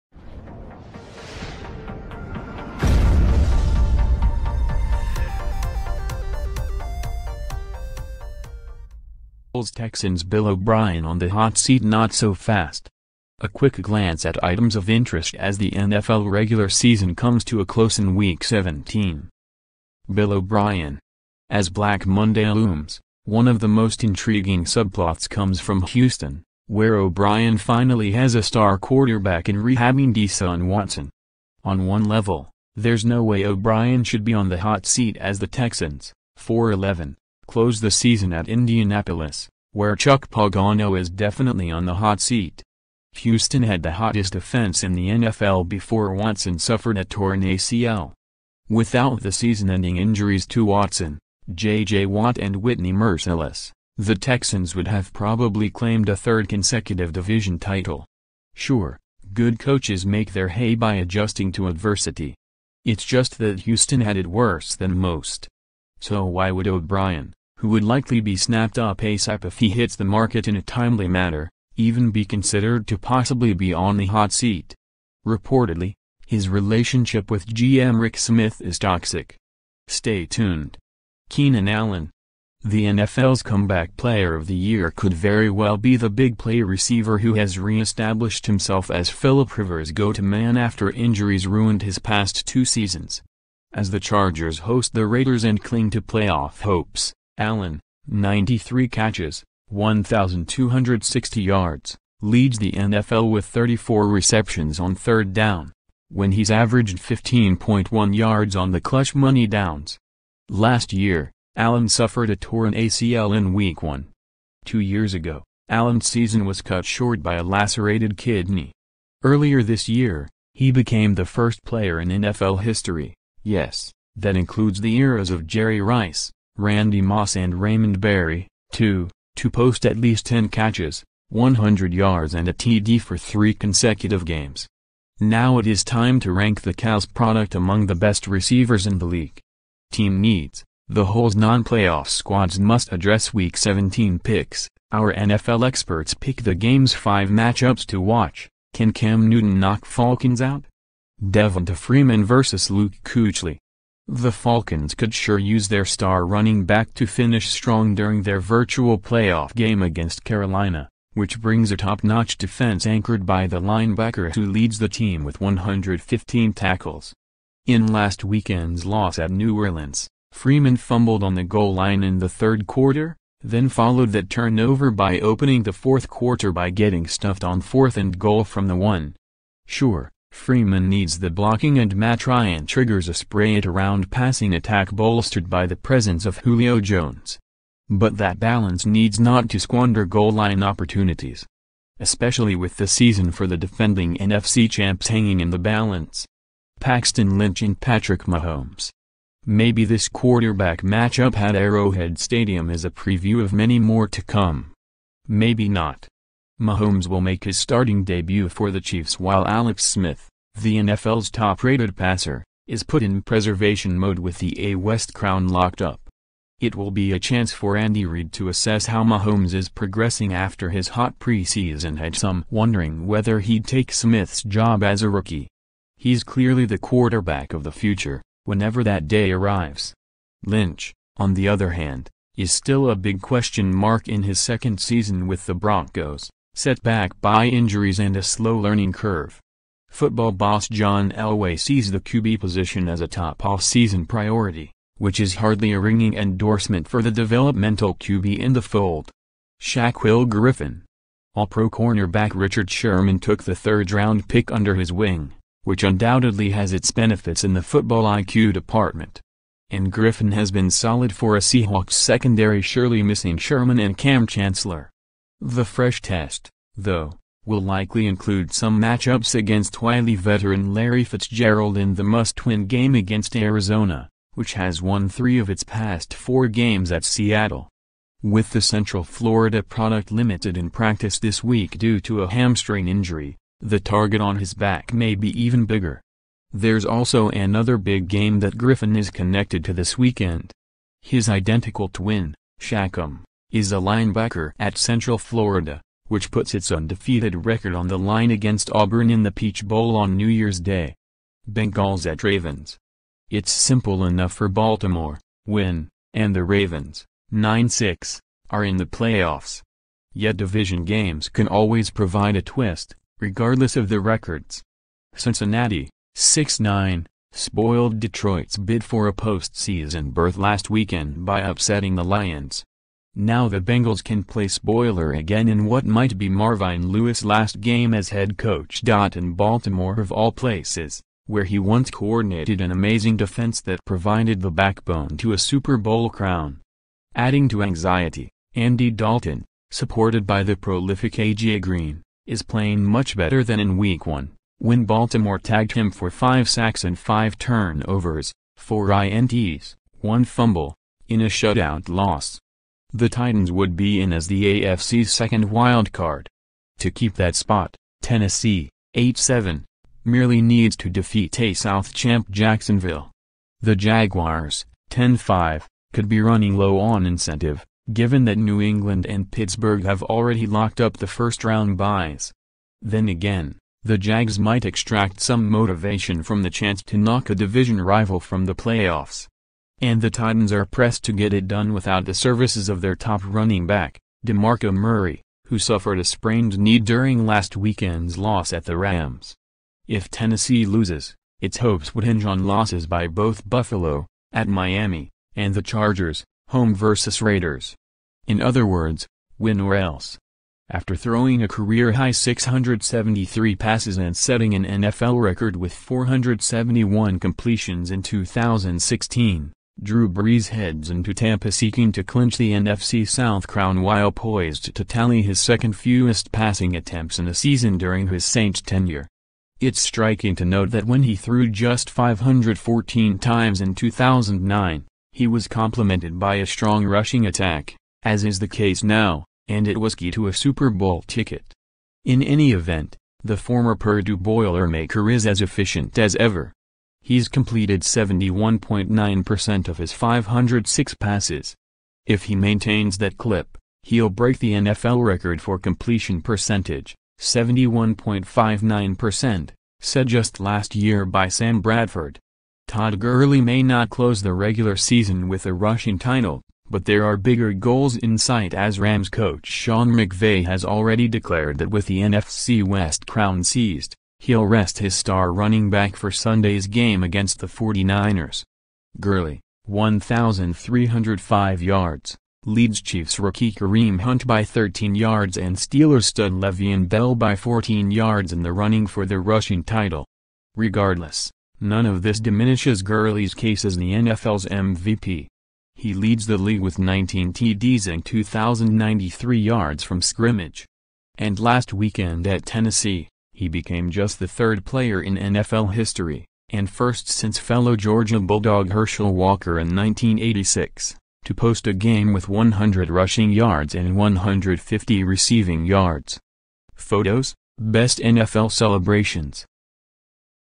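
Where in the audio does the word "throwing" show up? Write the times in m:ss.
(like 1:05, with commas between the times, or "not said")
6:40.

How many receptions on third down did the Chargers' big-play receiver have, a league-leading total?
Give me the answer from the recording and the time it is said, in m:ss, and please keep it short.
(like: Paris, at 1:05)
34, at 1:43.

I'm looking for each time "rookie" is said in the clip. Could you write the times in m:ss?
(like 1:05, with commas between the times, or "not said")
3:45, 7:53.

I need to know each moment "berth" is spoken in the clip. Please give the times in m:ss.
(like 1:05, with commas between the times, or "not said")
5:20.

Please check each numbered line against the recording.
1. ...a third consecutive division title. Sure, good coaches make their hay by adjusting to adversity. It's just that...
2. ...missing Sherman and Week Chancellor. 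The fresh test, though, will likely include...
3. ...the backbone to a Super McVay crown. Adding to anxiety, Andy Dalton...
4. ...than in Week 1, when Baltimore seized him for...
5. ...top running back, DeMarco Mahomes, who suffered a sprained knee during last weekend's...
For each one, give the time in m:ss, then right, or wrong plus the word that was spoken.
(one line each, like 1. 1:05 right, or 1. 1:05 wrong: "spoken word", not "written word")
1. 0:56 right
2. 4:23 wrong: "Kam", not "Week"
3. 5:34 wrong: "Bowl", not "McVay"
4. 5:43 wrong: "tagged", not "seized"
5. 6:22 wrong: "Murray", not "Mahomes".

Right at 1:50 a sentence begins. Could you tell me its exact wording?
Last year, Allen suffered a torn ACL in Week 1.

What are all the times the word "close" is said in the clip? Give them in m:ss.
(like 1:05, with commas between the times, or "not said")
0:17, 0:37, 7:33.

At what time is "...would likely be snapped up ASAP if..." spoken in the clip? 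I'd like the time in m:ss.
1:07.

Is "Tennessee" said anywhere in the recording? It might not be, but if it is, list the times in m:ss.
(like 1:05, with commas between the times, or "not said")
5:58, 6:30, 8:12.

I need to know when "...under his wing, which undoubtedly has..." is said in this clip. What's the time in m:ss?
4:14.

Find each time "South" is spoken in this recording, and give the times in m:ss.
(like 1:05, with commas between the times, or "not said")
6:01, 6:53.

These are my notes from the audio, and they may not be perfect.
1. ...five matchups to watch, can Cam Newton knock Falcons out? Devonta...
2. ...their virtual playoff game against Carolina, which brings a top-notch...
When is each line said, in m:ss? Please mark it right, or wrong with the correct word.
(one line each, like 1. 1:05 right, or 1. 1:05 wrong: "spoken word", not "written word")
1. 2:26 right
2. 2:38 right.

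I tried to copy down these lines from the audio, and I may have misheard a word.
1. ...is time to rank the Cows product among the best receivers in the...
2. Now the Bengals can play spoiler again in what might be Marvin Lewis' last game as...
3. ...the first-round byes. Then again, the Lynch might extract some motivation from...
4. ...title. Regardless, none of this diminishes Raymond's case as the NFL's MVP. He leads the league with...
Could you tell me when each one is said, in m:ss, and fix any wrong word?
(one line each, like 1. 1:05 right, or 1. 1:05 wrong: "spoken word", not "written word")
1. 2:15 right
2. 5:23 right
3. 6:10 wrong: "Jags", not "Lynch"
4. 7:59 wrong: "Gurley", not "Raymond".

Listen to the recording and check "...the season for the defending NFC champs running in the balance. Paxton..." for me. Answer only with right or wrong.
wrong.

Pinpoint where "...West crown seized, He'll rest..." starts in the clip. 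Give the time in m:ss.
7:42.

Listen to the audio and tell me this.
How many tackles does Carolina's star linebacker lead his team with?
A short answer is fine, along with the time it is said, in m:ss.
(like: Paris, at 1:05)
115, at 2:45.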